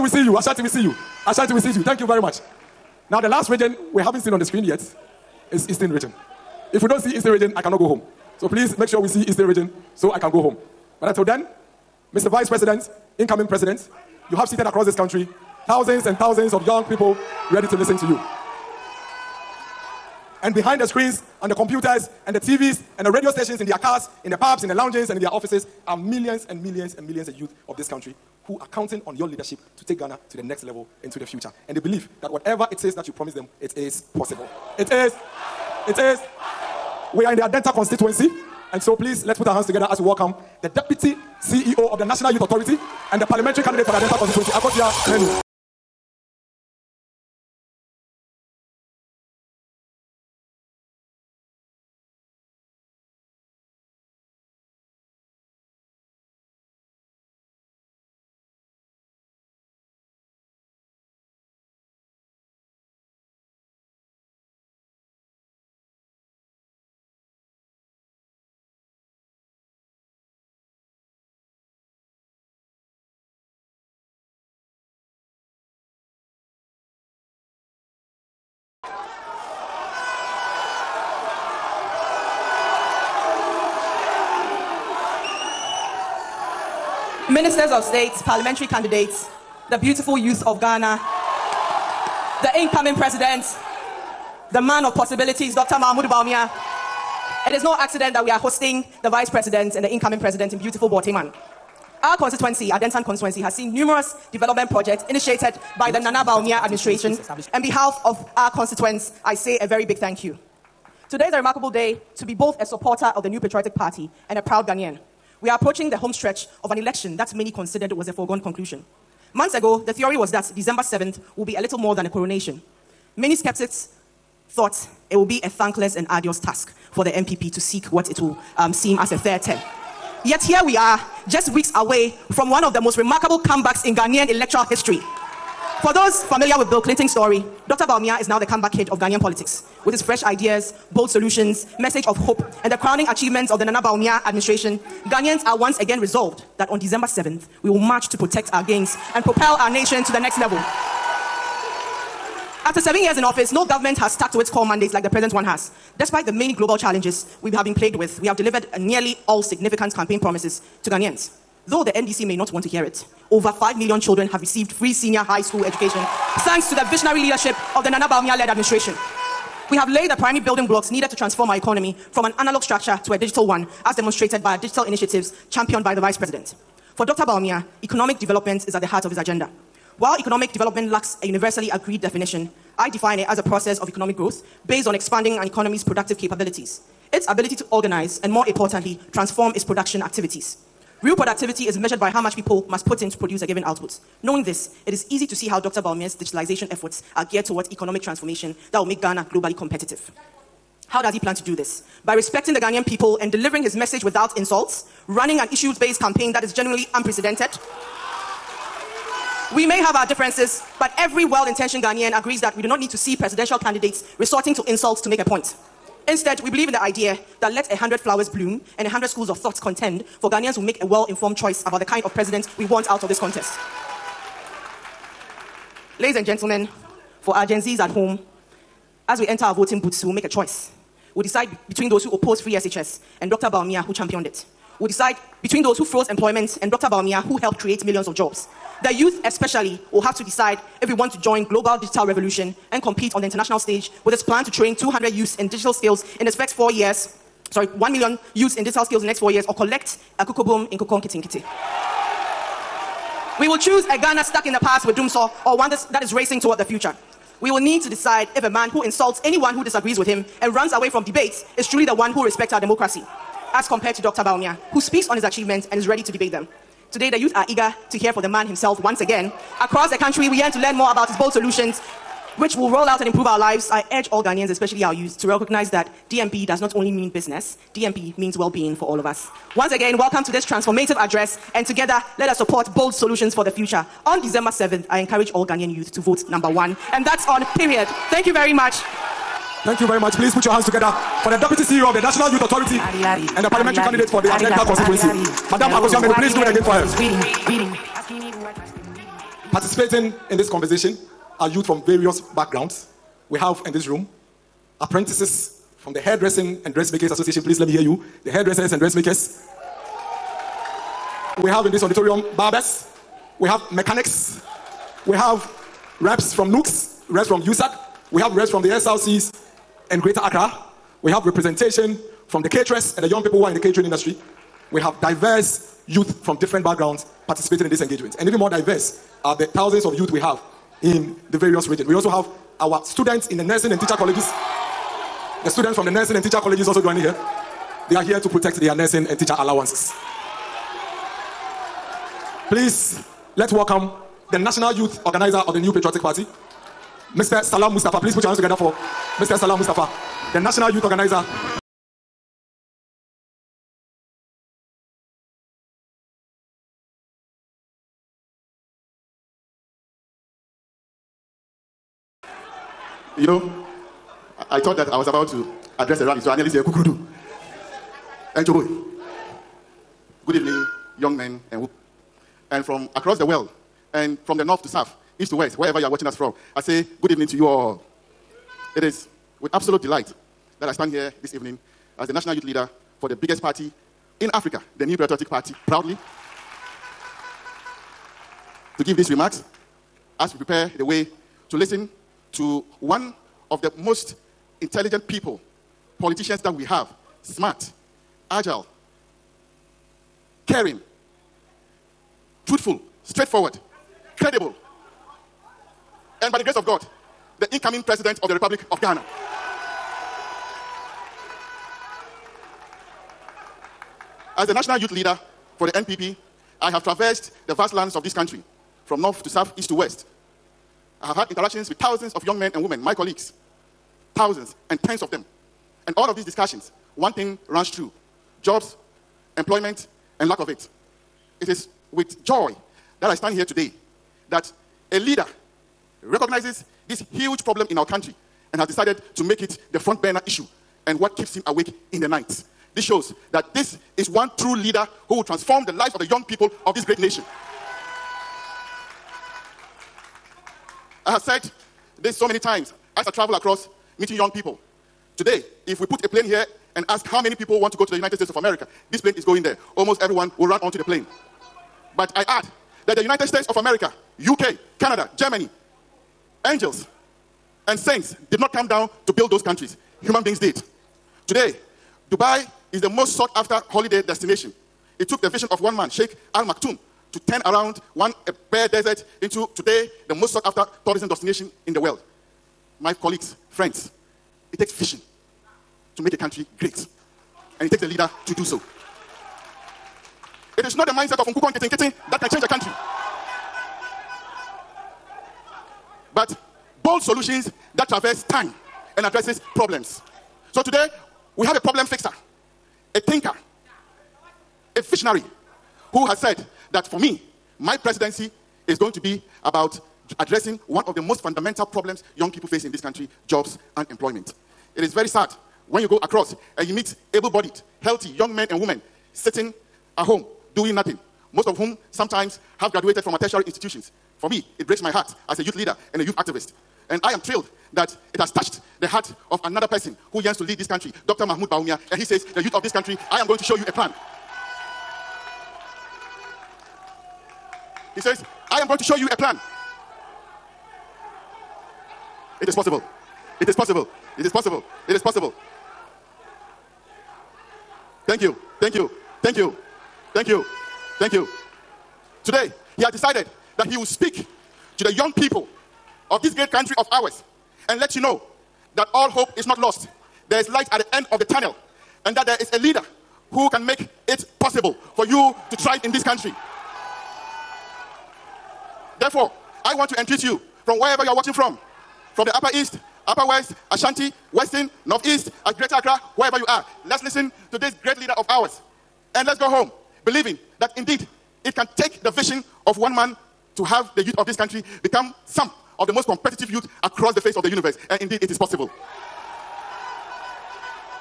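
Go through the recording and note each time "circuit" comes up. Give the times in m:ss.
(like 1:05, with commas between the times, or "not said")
not said.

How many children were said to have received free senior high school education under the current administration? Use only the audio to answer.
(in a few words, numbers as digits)
over 5 million.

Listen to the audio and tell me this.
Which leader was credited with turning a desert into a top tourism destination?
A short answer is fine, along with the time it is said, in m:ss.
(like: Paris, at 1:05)
Sheikh Al Maktoum, at 7:55.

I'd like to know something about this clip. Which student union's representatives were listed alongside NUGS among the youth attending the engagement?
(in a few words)
USAG.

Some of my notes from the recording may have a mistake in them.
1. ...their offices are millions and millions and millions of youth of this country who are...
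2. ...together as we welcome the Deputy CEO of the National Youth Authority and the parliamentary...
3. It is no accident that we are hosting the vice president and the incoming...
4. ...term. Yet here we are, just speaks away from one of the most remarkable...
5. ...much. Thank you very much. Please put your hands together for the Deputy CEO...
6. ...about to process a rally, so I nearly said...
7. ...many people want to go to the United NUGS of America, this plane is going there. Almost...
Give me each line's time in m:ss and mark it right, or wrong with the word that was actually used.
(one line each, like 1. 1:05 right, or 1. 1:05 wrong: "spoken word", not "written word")
1. 0:25 right
2. 0:39 right
3. 1:37 right
4. 2:09 wrong: "weeks", not "speaks"
5. 4:48 right
6. 6:05 wrong: "address", not "process"
7. 7:37 wrong: "States", not "NUGS".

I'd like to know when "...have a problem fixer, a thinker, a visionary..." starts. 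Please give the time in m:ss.
8:21.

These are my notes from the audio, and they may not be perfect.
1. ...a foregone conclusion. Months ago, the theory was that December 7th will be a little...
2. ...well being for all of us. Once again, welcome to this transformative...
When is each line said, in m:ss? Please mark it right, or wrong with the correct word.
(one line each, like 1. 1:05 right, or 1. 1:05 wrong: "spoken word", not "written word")
1. 1:58 right
2. 4:38 right.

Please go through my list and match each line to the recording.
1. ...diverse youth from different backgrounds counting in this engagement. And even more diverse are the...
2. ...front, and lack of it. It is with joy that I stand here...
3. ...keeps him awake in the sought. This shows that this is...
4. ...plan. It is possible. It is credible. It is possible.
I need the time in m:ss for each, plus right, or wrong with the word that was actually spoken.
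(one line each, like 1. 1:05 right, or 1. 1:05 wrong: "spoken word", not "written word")
1. 5:25 wrong: "participating", not "counting"
2. 7:09 wrong: "employment", not "front"
3. 7:21 wrong: "night", not "sought"
4. 8:59 wrong: "possible", not "credible".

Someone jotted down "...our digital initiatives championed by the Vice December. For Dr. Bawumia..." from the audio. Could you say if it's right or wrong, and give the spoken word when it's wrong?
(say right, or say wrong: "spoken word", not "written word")
wrong: "President", not "December".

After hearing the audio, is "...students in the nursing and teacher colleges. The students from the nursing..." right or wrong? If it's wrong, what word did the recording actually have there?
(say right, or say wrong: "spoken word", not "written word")
right.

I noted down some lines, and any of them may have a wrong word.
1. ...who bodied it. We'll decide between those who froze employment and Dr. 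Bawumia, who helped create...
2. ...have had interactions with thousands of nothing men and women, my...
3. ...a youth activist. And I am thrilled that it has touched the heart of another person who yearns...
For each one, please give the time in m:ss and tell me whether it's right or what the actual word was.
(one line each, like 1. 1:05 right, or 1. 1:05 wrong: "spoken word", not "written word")
1. 3:53 wrong: "championed", not "bodied"
2. 7:01 wrong: "young", not "nothing"
3. 8:46 right.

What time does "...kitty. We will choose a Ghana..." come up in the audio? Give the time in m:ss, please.
4:10.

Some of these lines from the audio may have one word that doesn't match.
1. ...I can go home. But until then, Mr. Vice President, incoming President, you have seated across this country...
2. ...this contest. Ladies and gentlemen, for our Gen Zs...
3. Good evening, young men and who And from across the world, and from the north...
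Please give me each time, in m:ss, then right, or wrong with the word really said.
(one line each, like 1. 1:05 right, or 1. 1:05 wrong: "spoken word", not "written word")
1. 0:10 right
2. 3:43 right
3. 6:10 right.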